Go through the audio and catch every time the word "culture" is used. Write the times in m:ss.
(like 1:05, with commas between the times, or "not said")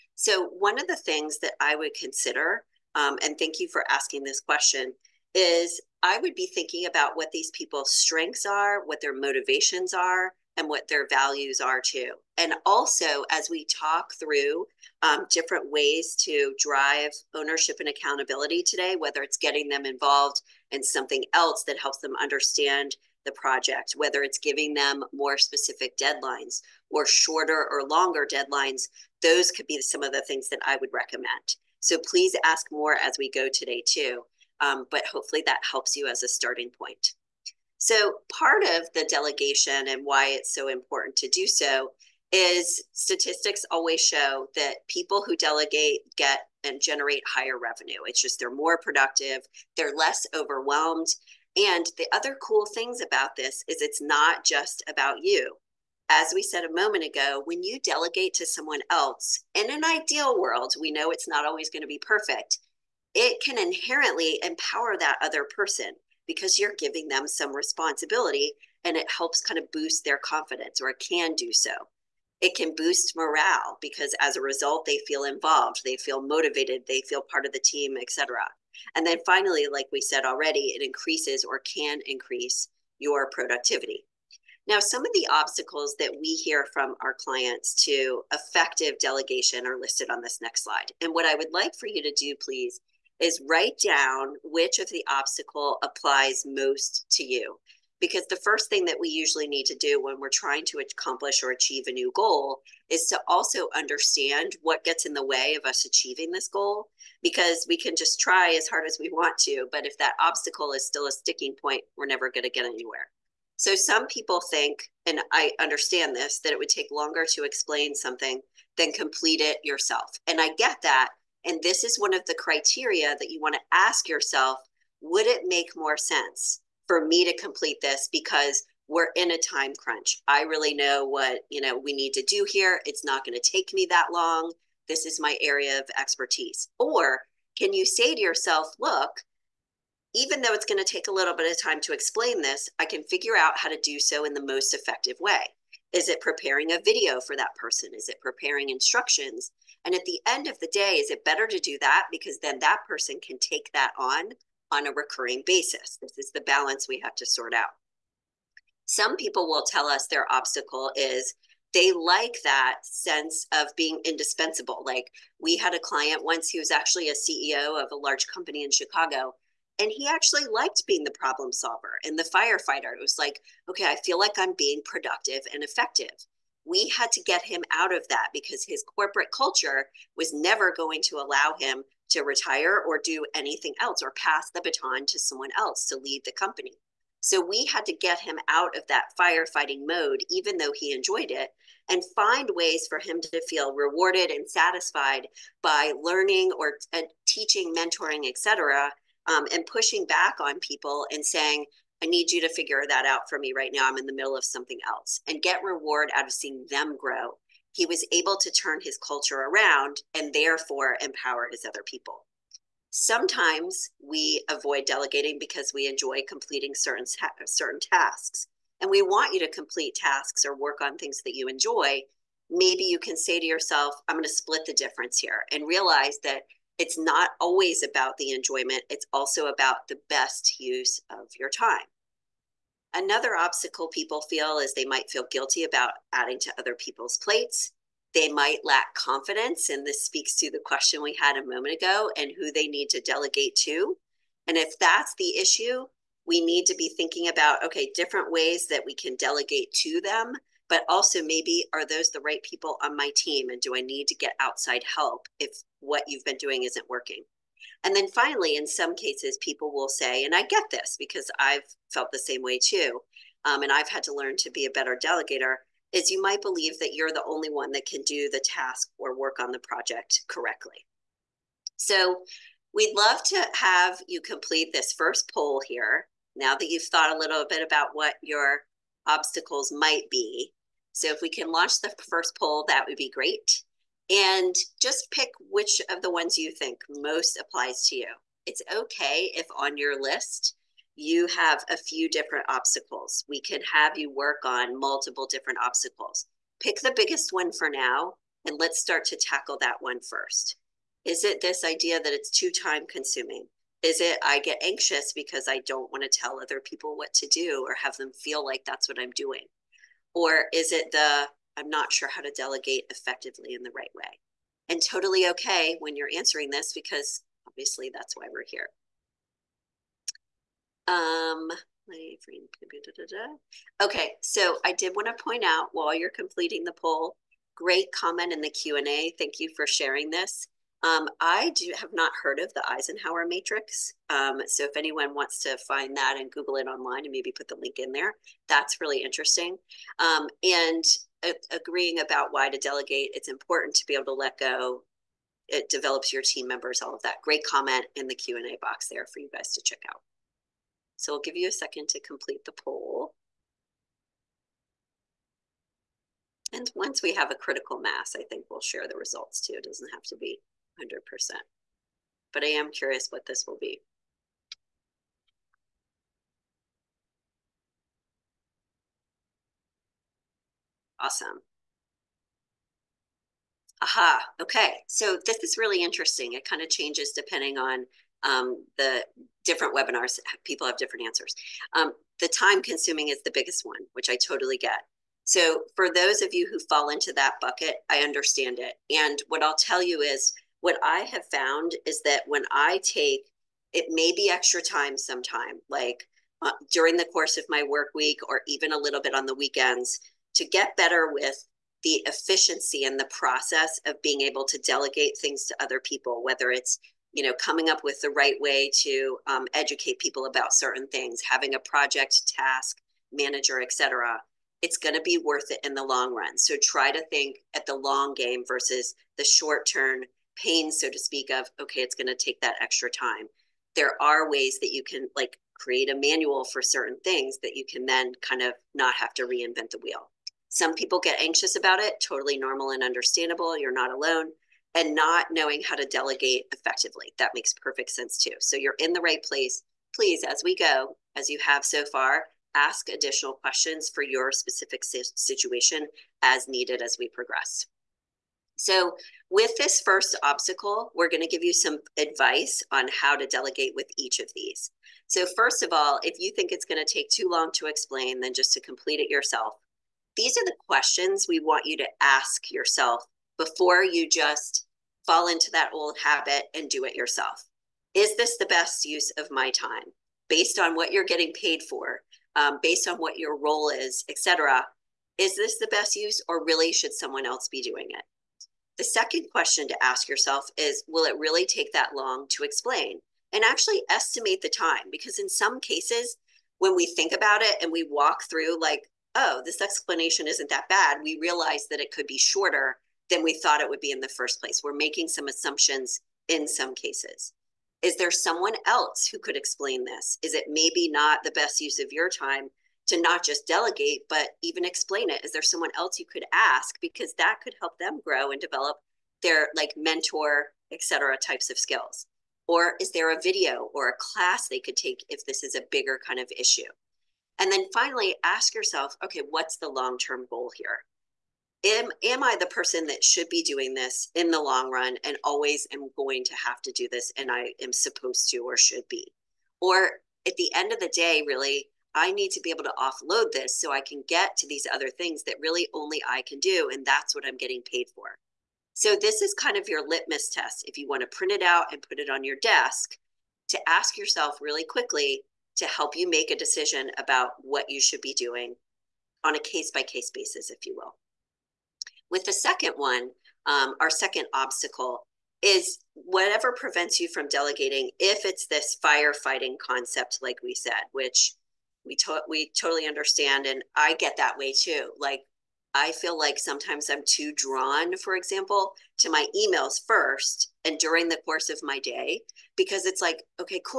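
2:59, 3:29.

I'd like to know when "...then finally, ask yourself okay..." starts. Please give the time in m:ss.
8:37.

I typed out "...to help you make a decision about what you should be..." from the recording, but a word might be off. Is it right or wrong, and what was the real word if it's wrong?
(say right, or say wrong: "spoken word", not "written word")
right.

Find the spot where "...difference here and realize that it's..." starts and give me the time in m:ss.
3:44.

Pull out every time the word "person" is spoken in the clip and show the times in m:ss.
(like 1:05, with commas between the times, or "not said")
1:05, 2:27, 2:32, 8:42.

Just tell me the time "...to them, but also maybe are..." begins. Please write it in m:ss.
4:09.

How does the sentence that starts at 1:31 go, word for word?
And what I would like for you to do, please, is write down which of the obstacle applies most to you.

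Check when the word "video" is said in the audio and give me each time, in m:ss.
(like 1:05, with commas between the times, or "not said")
2:26, 8:33.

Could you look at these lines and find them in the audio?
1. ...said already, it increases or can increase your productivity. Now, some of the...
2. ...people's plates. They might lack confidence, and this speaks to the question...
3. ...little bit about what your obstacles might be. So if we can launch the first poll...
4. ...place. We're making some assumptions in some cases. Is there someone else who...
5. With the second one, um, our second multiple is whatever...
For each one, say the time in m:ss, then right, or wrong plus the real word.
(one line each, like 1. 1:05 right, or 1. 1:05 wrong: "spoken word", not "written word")
1. 1:20 right
2. 3:56 right
3. 4:37 right
4. 8:14 right
5. 9:12 wrong: "obstacle", not "multiple".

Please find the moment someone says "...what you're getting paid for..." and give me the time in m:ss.
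7:50.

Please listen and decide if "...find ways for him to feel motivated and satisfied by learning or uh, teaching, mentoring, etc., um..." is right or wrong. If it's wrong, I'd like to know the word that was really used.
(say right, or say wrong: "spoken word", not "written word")
wrong: "rewarded", not "motivated".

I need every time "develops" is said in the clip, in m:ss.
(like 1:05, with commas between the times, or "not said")
5:45, 8:28.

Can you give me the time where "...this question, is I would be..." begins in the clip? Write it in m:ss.
0:04.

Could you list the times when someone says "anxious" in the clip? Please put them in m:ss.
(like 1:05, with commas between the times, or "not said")
5:04, 7:11.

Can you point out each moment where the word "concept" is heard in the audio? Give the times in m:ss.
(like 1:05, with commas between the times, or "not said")
9:19.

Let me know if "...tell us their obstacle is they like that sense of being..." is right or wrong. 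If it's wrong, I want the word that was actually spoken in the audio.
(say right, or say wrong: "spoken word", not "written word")
right.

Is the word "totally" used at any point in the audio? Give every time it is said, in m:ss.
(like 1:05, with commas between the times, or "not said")
5:14, 6:24, 7:12, 9:22.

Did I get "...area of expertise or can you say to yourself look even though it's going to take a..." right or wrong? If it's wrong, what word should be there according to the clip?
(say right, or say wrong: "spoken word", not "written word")
right.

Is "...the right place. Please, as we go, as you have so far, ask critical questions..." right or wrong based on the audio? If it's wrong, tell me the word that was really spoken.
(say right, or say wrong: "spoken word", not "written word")
wrong: "additional", not "critical".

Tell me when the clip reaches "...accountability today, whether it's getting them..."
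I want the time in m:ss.
0:17.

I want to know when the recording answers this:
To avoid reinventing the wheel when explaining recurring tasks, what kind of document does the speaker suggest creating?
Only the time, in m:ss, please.
7:05.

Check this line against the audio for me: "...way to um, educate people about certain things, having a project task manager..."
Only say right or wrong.
right.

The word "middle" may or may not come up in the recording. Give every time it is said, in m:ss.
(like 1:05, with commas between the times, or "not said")
3:24.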